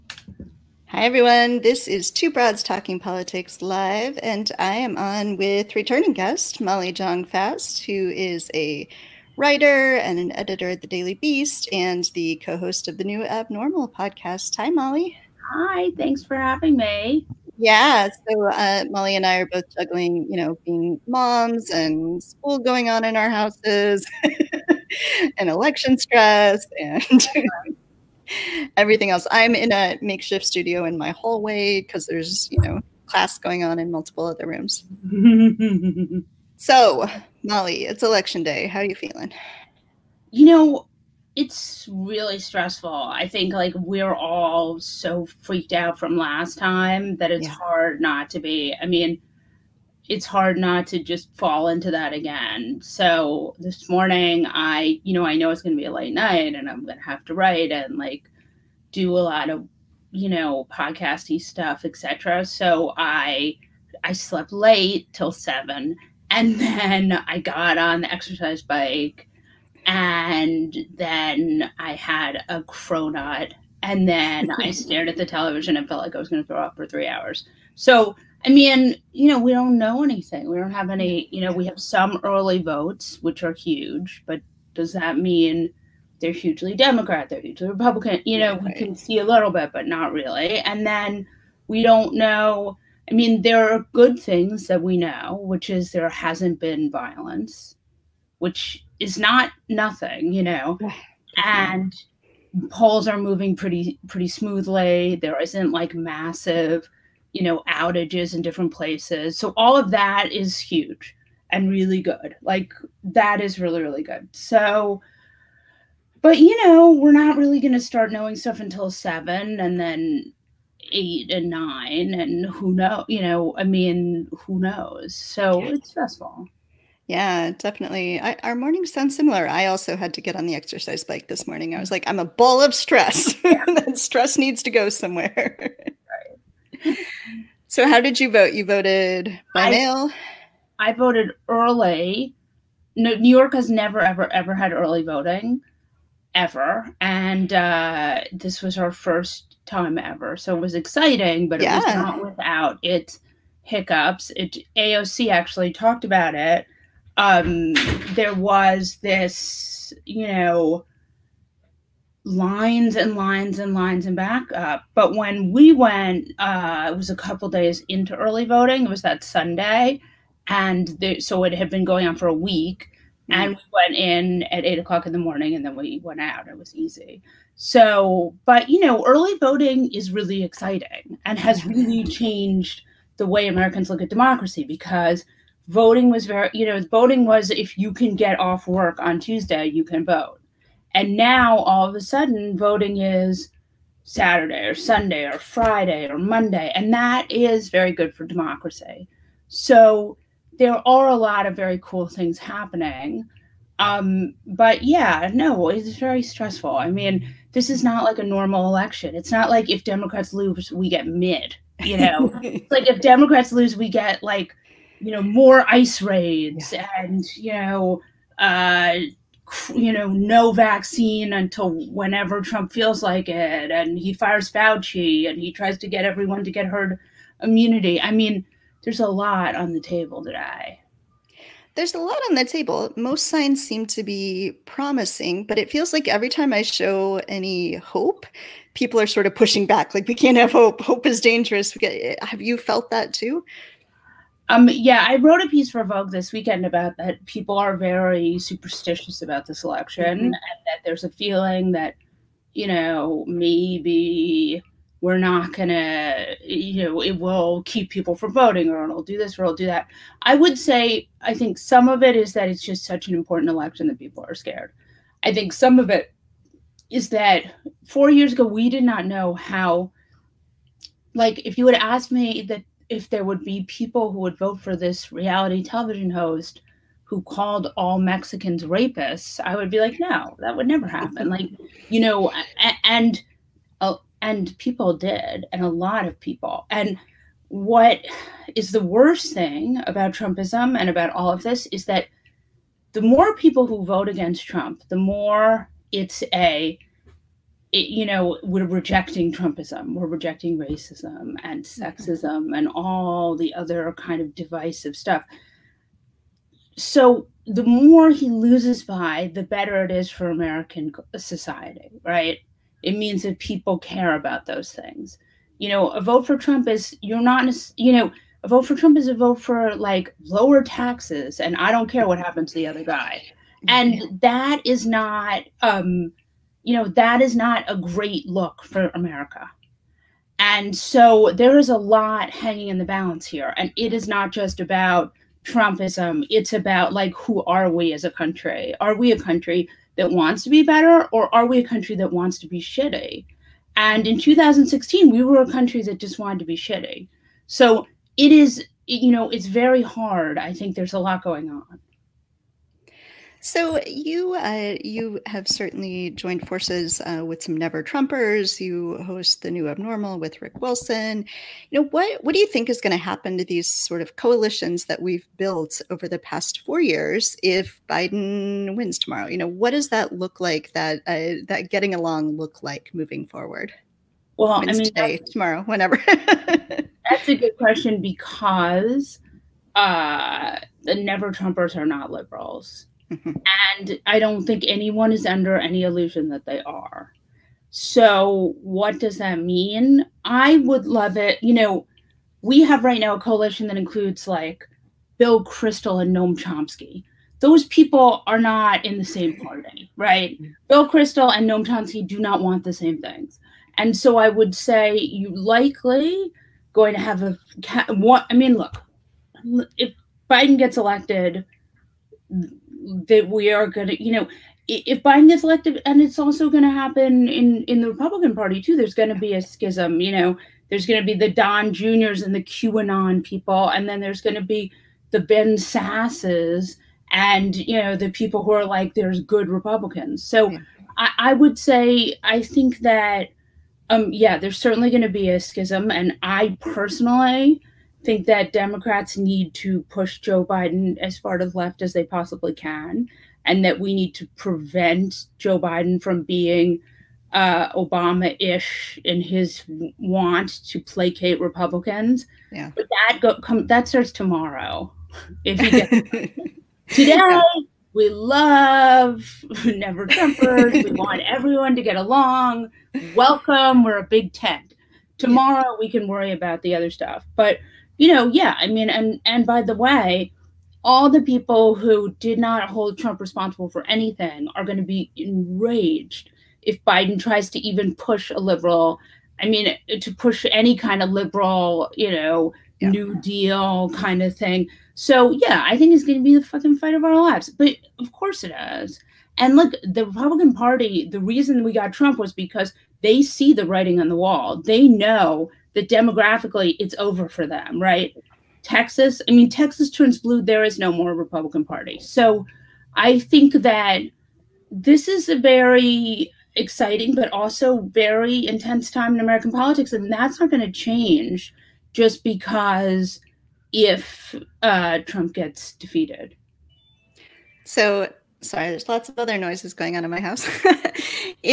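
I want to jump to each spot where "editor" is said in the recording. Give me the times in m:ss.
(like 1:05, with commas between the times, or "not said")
0:10.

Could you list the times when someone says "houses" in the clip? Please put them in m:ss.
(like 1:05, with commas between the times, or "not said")
0:23, 8:40.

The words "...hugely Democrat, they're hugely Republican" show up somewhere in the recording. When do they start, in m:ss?
1:26.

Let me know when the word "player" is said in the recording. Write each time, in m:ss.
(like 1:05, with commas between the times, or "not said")
not said.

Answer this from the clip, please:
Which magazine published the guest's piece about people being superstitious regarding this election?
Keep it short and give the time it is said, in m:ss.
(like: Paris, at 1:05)
Vogue, at 4:05.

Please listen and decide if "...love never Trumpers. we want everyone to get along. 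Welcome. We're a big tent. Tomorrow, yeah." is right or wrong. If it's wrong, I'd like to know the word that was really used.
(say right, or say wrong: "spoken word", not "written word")
right.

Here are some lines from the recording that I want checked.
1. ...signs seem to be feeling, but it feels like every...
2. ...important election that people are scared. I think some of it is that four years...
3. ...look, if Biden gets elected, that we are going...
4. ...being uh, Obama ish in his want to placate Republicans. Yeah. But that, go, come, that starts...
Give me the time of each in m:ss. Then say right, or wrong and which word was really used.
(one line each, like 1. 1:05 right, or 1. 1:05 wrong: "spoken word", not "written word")
1. 3:53 wrong: "promising", not "feeling"
2. 4:23 right
3. 6:48 right
4. 7:26 right.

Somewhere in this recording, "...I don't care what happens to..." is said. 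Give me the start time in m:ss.
5:21.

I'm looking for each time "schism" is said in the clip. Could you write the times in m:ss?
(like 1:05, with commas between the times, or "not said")
6:59, 7:15.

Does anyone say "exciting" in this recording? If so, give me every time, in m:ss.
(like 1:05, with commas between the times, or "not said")
2:30, 3:00, 8:26.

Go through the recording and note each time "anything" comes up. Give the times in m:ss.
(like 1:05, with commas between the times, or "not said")
1:20, 7:53.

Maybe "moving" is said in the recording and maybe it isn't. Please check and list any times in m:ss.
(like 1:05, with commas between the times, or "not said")
1:43, 6:12.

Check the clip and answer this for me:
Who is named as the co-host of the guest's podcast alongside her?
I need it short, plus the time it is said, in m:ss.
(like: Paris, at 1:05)
Rick Wilson, at 6:00.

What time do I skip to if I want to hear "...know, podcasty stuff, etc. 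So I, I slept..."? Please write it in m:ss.
1:00.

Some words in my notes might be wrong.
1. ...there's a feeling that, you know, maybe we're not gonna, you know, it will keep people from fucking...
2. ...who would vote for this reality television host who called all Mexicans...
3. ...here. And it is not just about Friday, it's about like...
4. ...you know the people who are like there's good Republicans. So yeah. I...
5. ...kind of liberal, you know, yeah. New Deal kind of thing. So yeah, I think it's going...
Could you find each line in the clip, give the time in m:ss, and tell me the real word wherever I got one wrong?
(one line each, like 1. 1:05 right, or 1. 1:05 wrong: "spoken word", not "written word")
1. 4:10 wrong: "voting", not "fucking"
2. 4:34 right
3. 5:33 wrong: "Trumpism", not "Friday"
4. 7:07 right
5. 8:00 right.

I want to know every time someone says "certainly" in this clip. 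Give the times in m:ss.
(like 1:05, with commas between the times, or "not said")
5:55, 7:14.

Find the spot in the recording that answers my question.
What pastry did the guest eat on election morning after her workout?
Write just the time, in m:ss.
1:12.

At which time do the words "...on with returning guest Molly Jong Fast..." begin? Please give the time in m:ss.
0:04.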